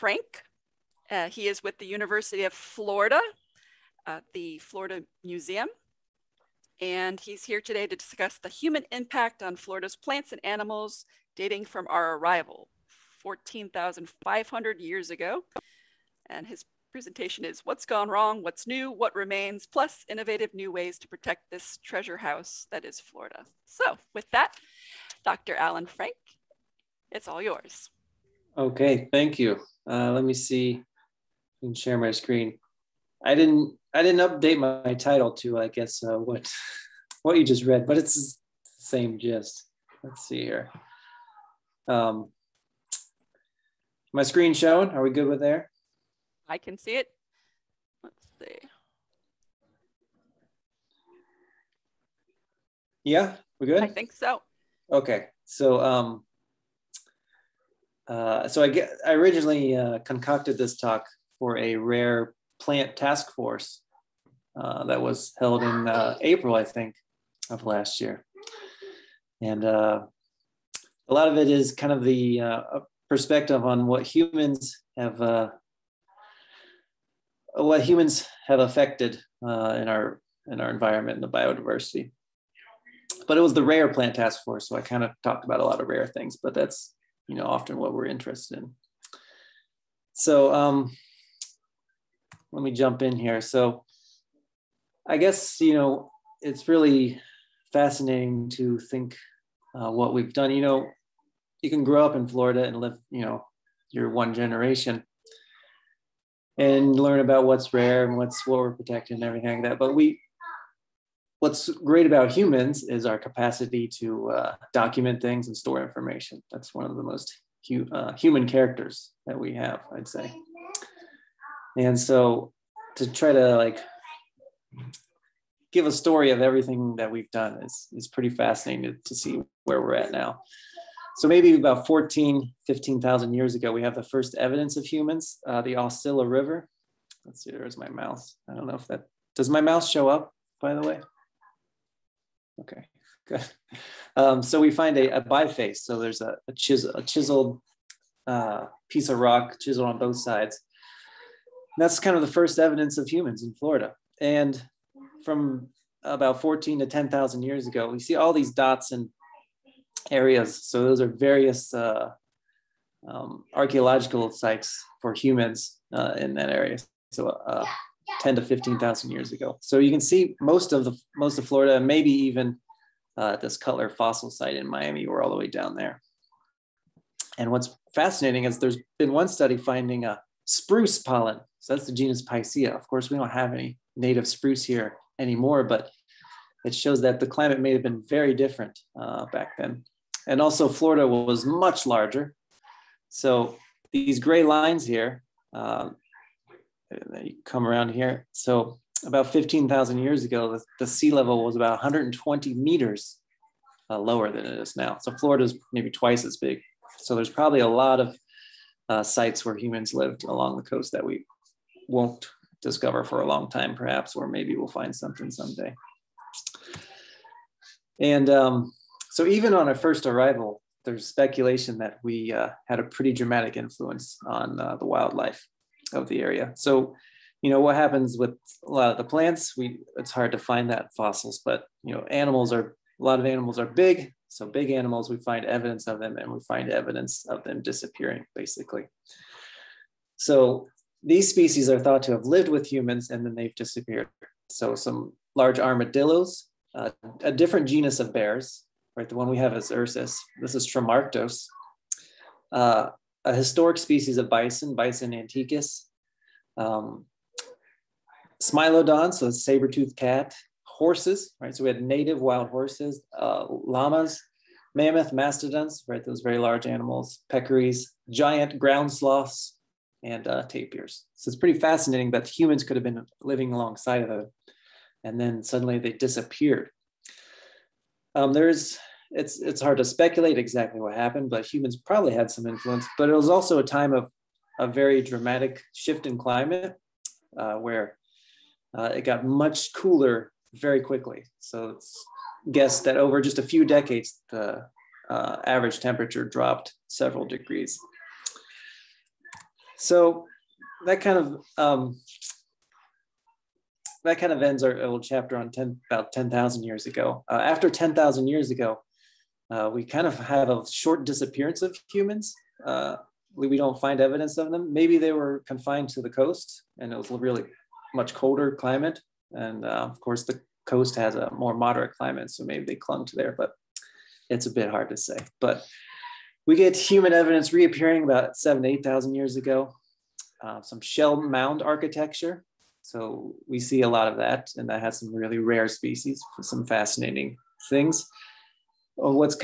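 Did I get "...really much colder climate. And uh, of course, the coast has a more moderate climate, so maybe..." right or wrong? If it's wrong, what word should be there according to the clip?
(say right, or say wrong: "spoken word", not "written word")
right.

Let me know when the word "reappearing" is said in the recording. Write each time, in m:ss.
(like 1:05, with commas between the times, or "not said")
5:27.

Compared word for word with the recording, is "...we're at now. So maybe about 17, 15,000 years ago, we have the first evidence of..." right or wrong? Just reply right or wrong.
wrong.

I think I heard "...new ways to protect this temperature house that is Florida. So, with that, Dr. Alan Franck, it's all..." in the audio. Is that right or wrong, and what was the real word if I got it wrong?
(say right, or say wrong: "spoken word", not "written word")
wrong: "treasure", not "temperature".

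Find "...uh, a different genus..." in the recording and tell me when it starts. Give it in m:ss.
4:06.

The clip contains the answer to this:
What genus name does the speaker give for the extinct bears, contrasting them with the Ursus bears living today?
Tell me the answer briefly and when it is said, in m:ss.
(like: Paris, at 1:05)
Tremarctos, at 4:10.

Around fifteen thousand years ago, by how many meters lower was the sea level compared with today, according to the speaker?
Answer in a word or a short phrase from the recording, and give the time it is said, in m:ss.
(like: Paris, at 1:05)
120 meters, at 3:21.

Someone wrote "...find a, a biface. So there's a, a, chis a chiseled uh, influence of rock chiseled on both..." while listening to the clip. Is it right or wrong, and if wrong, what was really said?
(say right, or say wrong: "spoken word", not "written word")
wrong: "piece", not "influence".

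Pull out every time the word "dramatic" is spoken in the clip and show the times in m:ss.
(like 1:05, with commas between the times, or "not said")
3:43, 4:45.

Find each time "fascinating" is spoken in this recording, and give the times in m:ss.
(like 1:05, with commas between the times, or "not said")
1:37, 2:08, 2:57, 4:31, 5:36.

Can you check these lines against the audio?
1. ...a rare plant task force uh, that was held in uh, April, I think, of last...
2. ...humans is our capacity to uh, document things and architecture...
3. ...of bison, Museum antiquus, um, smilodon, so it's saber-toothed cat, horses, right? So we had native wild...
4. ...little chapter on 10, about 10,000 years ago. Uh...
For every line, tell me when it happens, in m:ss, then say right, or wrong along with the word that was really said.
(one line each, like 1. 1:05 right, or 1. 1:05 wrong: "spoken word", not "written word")
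1. 1:01 right
2. 1:52 wrong: "store", not "architecture"
3. 4:14 wrong: "Bison", not "Museum"
4. 5:04 right.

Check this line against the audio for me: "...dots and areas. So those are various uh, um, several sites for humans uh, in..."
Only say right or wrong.
wrong.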